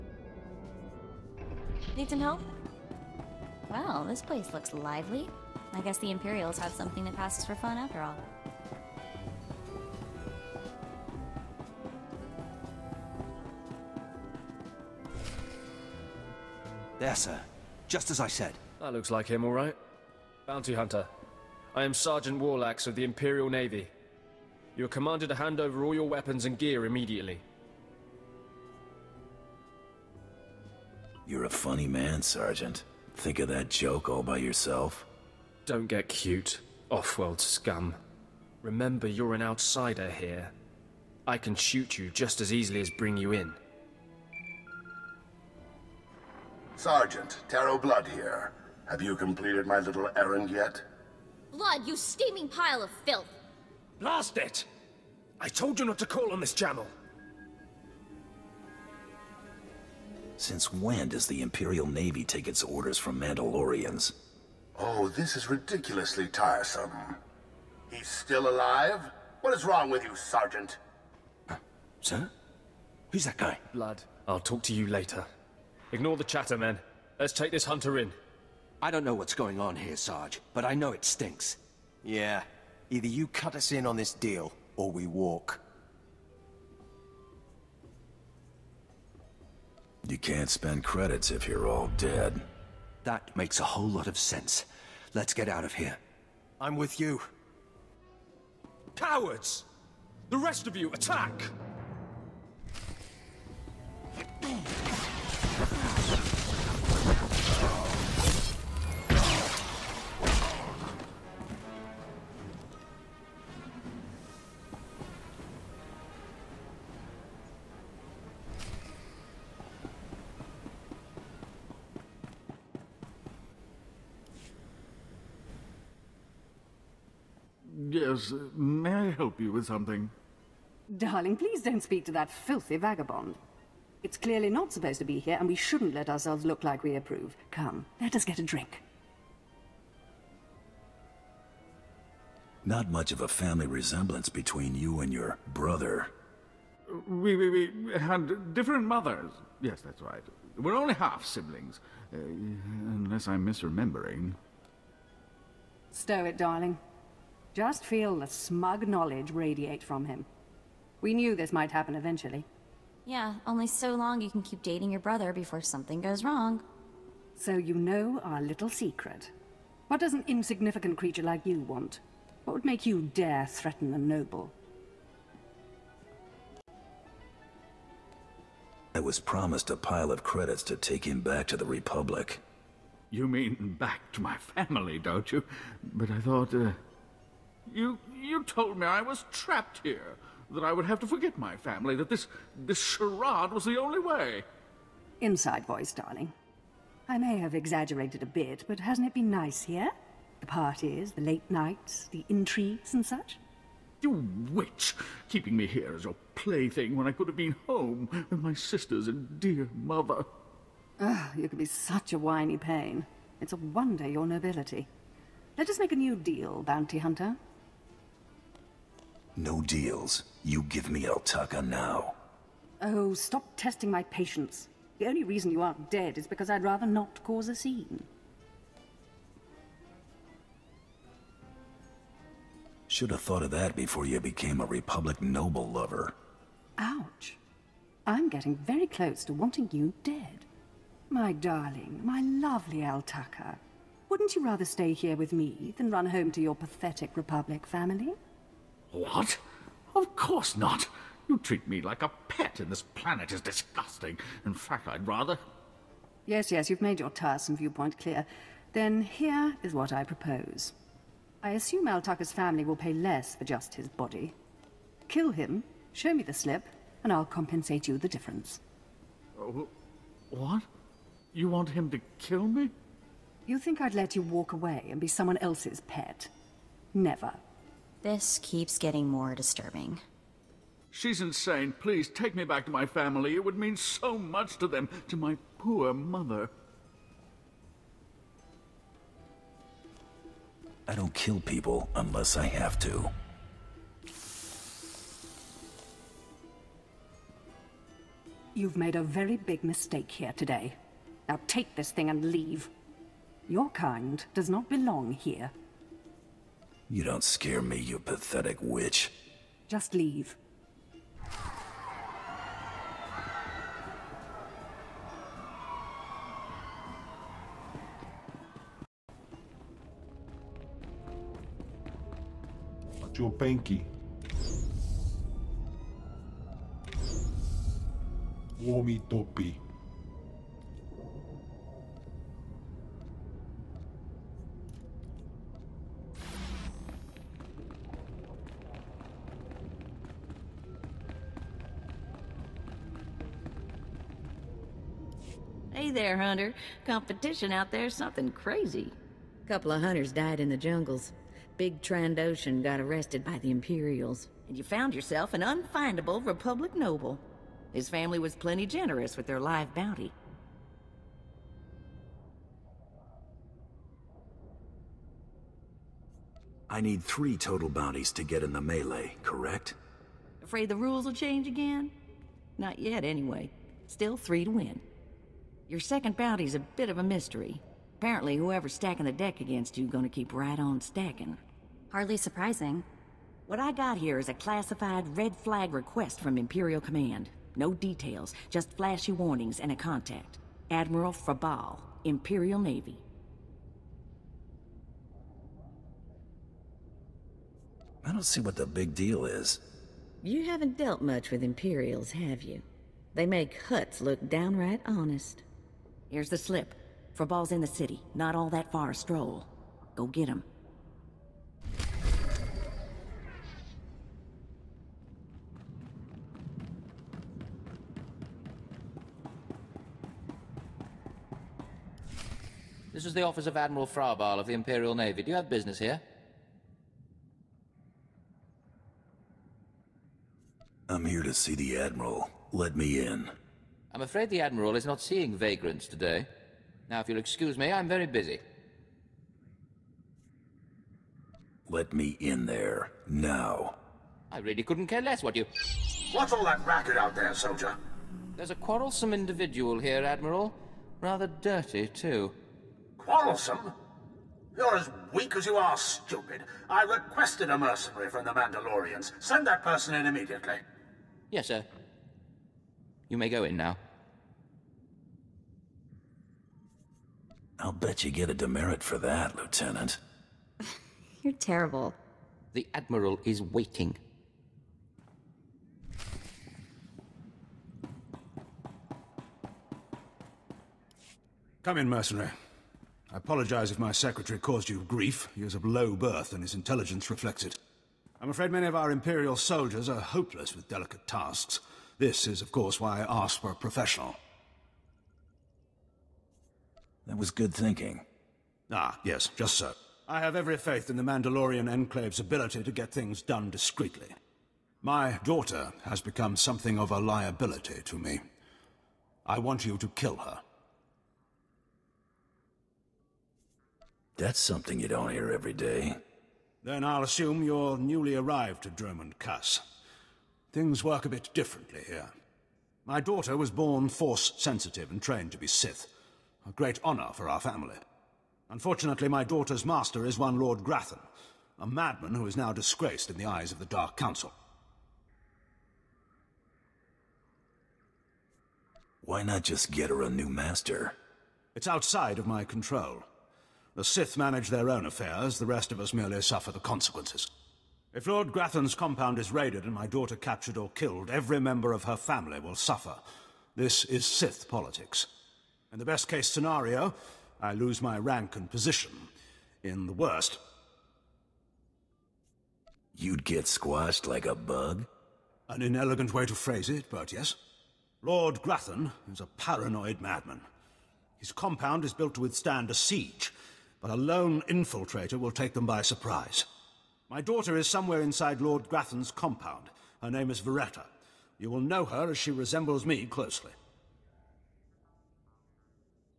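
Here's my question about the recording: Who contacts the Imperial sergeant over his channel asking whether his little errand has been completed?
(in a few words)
Tarro Blood.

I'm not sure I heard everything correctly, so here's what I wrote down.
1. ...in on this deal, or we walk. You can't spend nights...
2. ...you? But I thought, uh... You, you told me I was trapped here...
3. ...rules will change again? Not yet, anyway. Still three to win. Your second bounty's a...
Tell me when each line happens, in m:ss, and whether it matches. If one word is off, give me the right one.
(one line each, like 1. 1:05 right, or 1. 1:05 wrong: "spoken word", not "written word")
1. 1:23 wrong: "credits", not "nights"
2. 3:05 right
3. 6:10 right.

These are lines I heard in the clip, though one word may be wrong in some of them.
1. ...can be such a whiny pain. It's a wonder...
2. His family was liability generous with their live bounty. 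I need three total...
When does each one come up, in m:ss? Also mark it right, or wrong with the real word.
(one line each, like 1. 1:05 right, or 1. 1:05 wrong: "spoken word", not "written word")
1. 3:31 right
2. 5:57 wrong: "plenty", not "liability".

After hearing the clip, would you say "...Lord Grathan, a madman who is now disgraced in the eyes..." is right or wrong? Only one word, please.
right.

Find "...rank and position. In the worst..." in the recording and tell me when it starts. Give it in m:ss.
9:17.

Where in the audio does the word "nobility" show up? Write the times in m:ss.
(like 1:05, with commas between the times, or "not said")
3:34.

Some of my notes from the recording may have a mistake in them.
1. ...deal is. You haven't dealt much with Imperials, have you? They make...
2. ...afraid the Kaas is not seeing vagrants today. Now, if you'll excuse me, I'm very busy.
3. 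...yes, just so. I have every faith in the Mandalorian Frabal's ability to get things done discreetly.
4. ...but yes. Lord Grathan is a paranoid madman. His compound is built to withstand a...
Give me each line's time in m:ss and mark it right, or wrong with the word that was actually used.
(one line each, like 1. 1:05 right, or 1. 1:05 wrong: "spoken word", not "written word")
1. 6:38 right
2. 7:14 wrong: "Admiral", not "Kaas"
3. 8:19 wrong: "Enclave", not "Frabal"
4. 9:26 right.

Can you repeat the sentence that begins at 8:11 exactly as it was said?
This is, of course, why I asked for a professional.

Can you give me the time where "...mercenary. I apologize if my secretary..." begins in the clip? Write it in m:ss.
8:01.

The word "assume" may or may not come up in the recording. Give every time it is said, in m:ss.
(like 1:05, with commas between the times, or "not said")
4:21, 8:37.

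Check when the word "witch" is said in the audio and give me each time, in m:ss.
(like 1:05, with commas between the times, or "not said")
3:24, 5:08.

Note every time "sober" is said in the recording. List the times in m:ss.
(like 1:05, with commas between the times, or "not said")
not said.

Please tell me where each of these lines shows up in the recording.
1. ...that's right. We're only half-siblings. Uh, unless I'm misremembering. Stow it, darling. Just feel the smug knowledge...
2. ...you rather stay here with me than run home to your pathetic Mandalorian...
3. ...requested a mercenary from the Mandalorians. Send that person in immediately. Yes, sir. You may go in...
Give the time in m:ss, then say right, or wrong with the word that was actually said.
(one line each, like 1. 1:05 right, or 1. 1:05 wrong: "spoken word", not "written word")
1. 2:29 right
2. 4:04 wrong: "Republic", not "Mandalorian"
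3. 7:36 right.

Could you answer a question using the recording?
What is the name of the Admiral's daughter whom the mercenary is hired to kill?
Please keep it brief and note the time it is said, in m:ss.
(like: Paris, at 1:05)
Veretta, at 9:40.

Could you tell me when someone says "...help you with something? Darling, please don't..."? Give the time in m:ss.
2:09.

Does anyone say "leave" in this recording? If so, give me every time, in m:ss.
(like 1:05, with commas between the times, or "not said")
5:02, 5:09.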